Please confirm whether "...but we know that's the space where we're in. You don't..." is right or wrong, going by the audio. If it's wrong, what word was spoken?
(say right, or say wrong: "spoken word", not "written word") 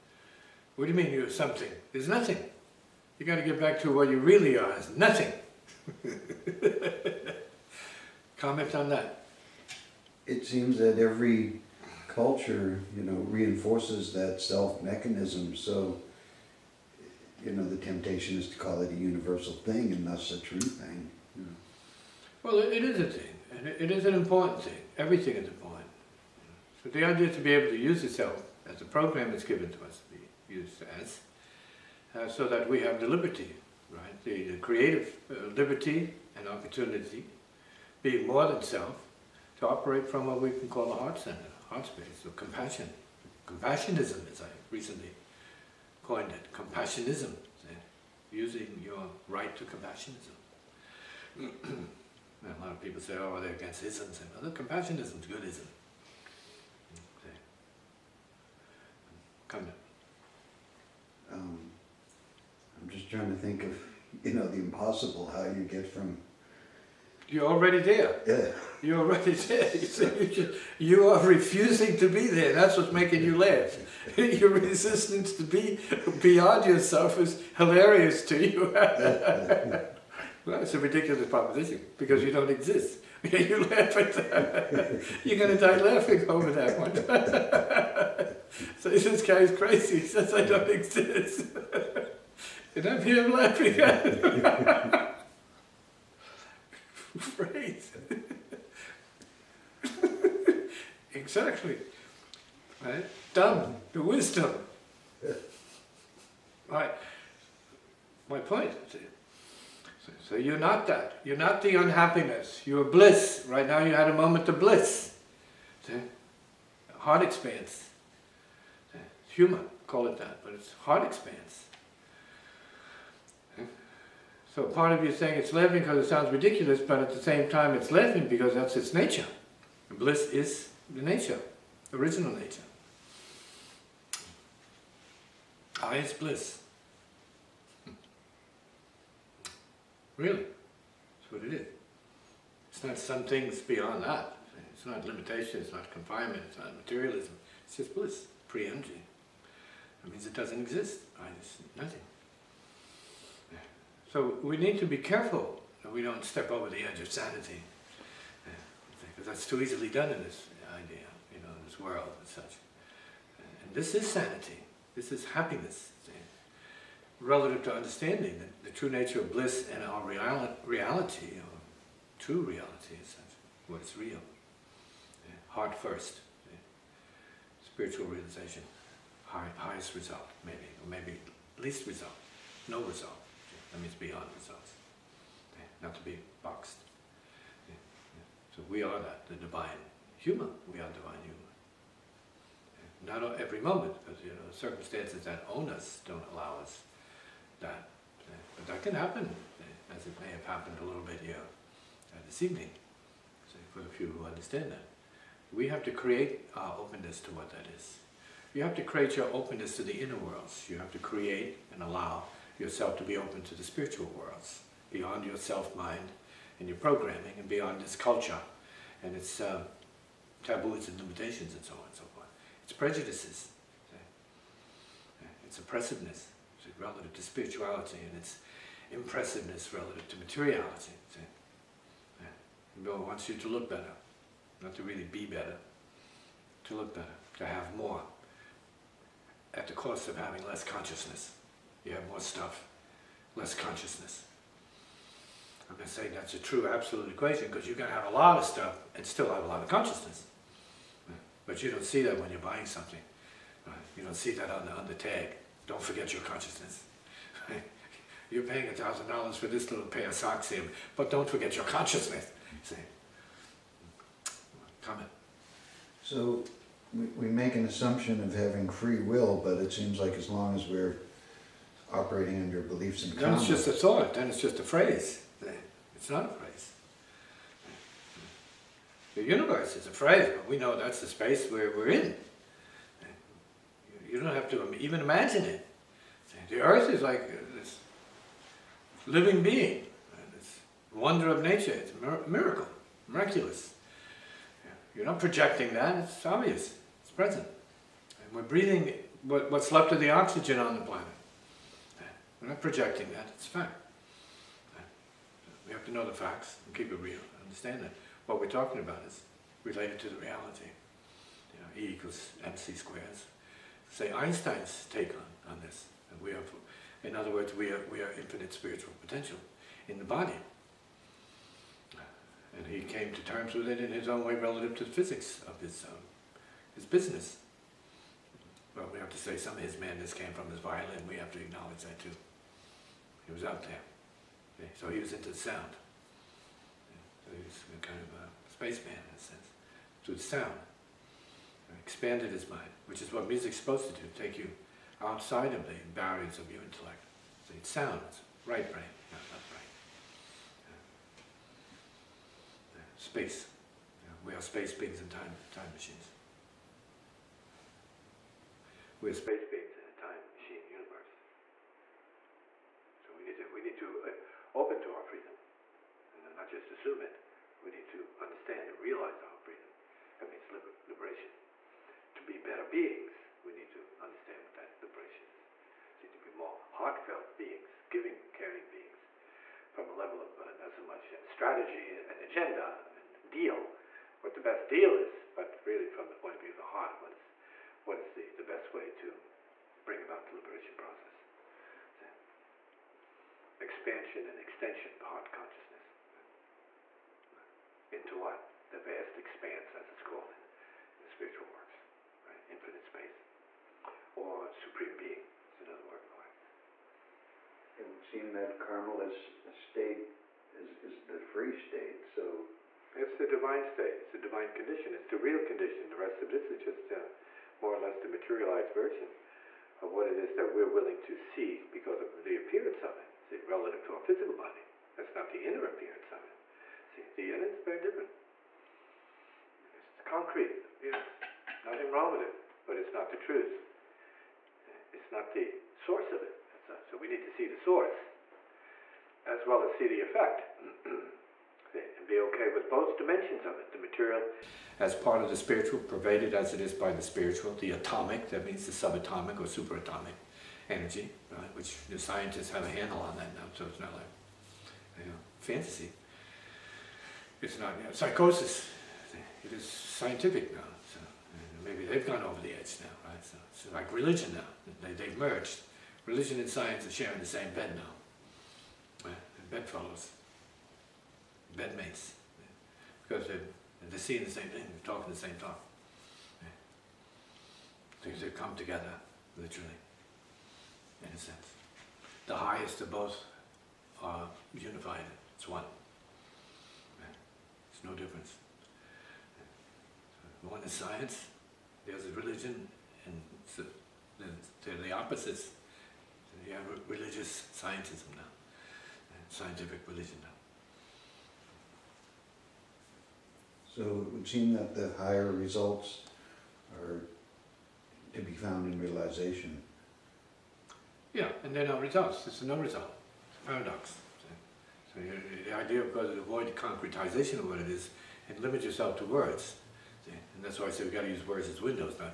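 right.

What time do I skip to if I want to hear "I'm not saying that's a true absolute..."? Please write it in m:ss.
4:05.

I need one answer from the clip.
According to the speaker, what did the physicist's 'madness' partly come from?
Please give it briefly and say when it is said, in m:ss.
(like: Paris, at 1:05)
his violin, at 5:30.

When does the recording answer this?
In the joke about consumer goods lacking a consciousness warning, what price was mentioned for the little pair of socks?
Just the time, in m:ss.
4:18.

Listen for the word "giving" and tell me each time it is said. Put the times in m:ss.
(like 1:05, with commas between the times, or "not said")
6:17.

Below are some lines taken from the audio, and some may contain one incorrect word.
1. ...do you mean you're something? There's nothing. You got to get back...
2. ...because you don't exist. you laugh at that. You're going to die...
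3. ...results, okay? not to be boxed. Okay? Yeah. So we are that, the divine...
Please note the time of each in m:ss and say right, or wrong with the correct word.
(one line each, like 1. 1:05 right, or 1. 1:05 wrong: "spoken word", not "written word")
1. 0:00 right
2. 1:21 right
3. 3:04 right.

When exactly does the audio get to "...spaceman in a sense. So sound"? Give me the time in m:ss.
5:38.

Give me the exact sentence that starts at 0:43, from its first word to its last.
Compassionism, as I recently coined it, compassionism, using your right to compassionism.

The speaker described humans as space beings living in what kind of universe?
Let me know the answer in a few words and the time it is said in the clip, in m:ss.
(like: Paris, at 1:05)
time machine universe, at 6:00.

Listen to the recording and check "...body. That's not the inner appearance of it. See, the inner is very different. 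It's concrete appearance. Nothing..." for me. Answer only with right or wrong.
right.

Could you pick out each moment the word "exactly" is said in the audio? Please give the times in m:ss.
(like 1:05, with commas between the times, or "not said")
1:41.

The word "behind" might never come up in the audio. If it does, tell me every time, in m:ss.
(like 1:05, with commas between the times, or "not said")
6:34.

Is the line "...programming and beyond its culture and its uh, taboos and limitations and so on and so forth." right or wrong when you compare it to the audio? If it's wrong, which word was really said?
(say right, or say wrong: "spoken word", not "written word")
right.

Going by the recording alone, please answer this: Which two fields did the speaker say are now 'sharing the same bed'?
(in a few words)
religion and science.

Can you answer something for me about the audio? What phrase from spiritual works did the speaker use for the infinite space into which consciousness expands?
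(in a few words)
the vast expanse.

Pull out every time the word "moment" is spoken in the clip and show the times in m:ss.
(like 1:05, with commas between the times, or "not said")
1:54, 3:13.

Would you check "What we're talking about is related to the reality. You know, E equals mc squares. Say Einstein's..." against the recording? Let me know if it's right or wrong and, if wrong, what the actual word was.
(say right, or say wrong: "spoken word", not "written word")
right.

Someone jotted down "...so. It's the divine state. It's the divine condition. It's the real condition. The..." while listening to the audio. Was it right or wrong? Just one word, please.
right.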